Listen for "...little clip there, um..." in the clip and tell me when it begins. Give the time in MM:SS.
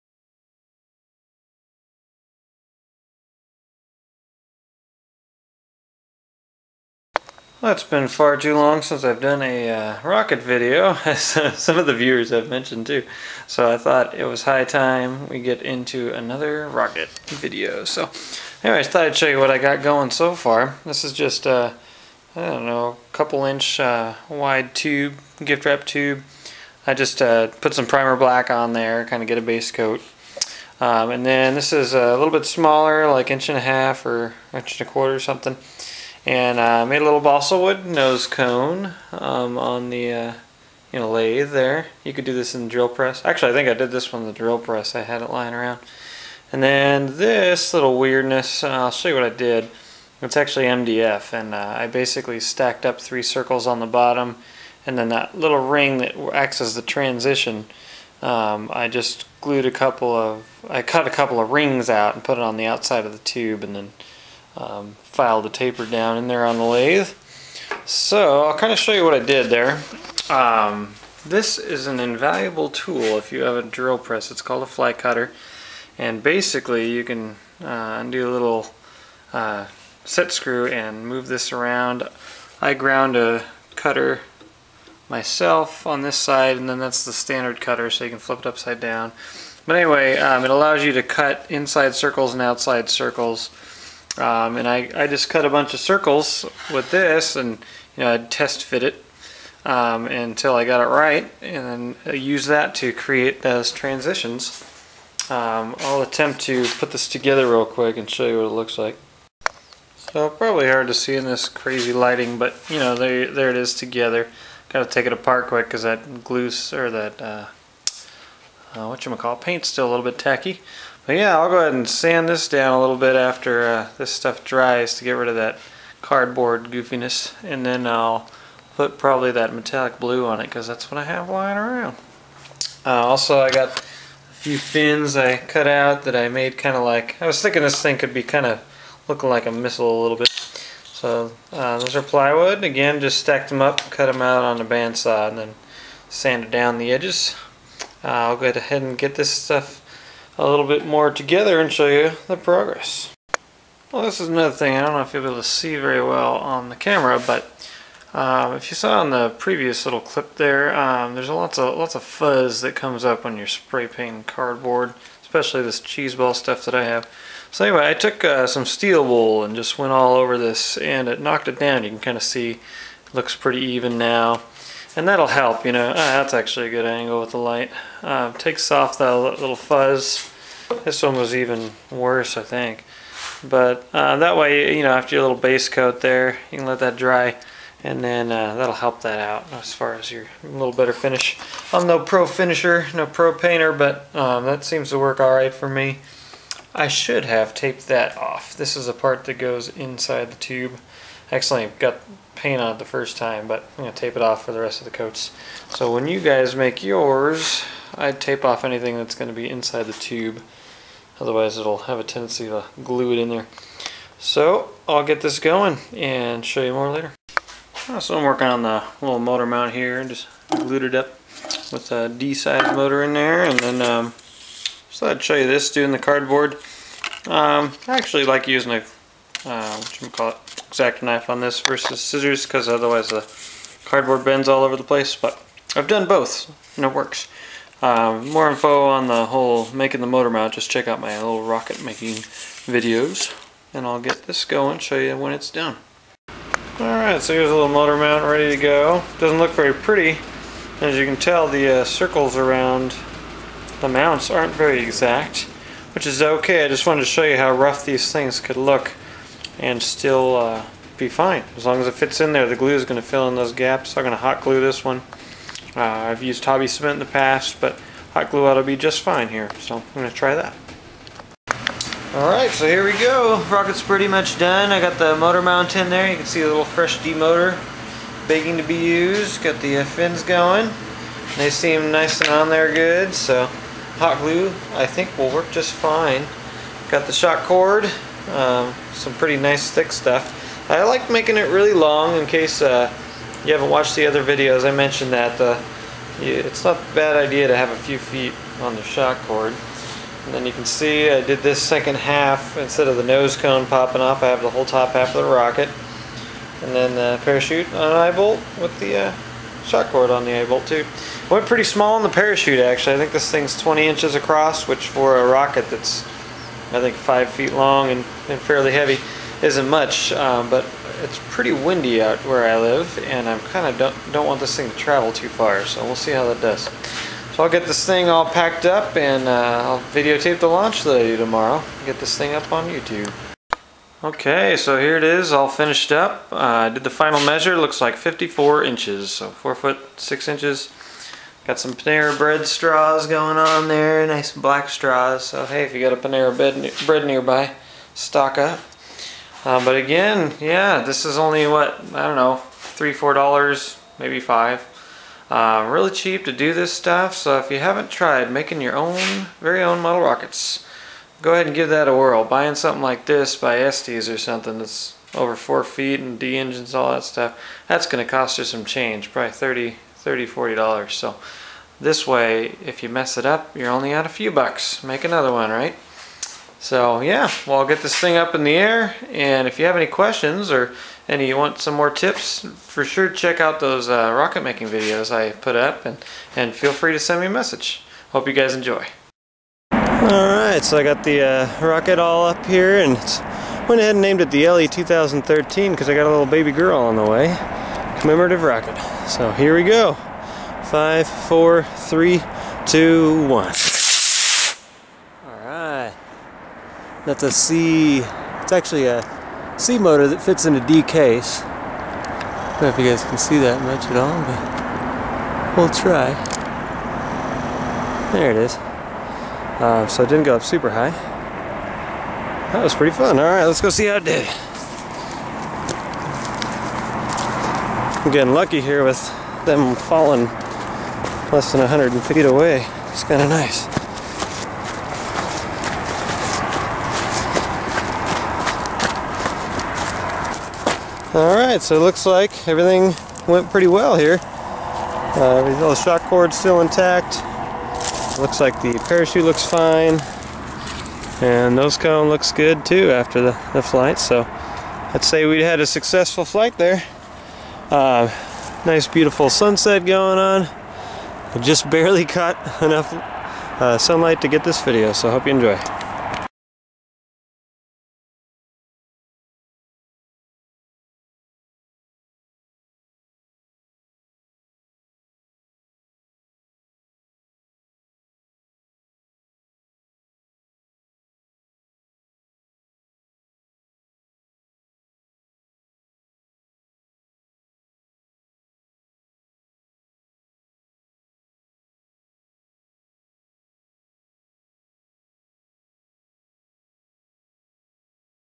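02:39.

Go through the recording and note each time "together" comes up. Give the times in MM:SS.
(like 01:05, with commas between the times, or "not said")
01:47, 01:53, 02:31.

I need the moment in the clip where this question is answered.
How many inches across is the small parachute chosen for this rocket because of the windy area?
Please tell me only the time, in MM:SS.
05:13.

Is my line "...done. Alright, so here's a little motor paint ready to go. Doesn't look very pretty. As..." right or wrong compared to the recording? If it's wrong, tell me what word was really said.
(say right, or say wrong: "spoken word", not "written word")
wrong: "mount", not "paint".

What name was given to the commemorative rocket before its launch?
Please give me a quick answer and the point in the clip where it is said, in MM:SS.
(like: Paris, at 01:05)
LE 2013, at 06:34.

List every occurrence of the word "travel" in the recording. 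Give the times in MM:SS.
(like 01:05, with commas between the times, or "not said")
05:24.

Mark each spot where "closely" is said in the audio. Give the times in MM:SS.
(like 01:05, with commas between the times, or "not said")
not said.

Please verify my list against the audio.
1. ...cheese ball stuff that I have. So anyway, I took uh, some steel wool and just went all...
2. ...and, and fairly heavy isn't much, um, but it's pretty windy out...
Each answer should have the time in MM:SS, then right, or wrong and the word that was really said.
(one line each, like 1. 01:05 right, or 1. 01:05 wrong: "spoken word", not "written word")
1. 02:45 right
2. 05:17 right.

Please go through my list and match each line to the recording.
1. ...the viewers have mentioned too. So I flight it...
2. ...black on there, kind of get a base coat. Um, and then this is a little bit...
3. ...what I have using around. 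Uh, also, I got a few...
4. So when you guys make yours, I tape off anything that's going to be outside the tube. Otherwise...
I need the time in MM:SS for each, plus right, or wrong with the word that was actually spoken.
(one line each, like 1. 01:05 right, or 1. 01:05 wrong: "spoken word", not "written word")
1. 00:11 wrong: "thought", not "flight"
2. 00:28 right
3. 02:10 wrong: "lying", not "using"
4. 03:25 wrong: "inside", not "outside".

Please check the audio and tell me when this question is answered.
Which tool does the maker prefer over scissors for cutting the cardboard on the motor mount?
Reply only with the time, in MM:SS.
03:50.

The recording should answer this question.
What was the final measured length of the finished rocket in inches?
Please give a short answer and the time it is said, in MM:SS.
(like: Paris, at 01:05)
54 inches, at 05:37.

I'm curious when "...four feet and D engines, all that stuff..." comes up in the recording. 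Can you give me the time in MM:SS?
06:05.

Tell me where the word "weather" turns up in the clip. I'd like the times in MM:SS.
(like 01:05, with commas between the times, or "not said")
not said.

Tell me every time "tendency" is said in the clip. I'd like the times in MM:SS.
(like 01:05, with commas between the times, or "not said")
03:32.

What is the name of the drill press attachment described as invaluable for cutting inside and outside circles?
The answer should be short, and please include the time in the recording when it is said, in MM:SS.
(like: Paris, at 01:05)
Fly cutter, at 01:14.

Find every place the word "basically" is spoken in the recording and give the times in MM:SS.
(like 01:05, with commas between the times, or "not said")
00:51, 01:16.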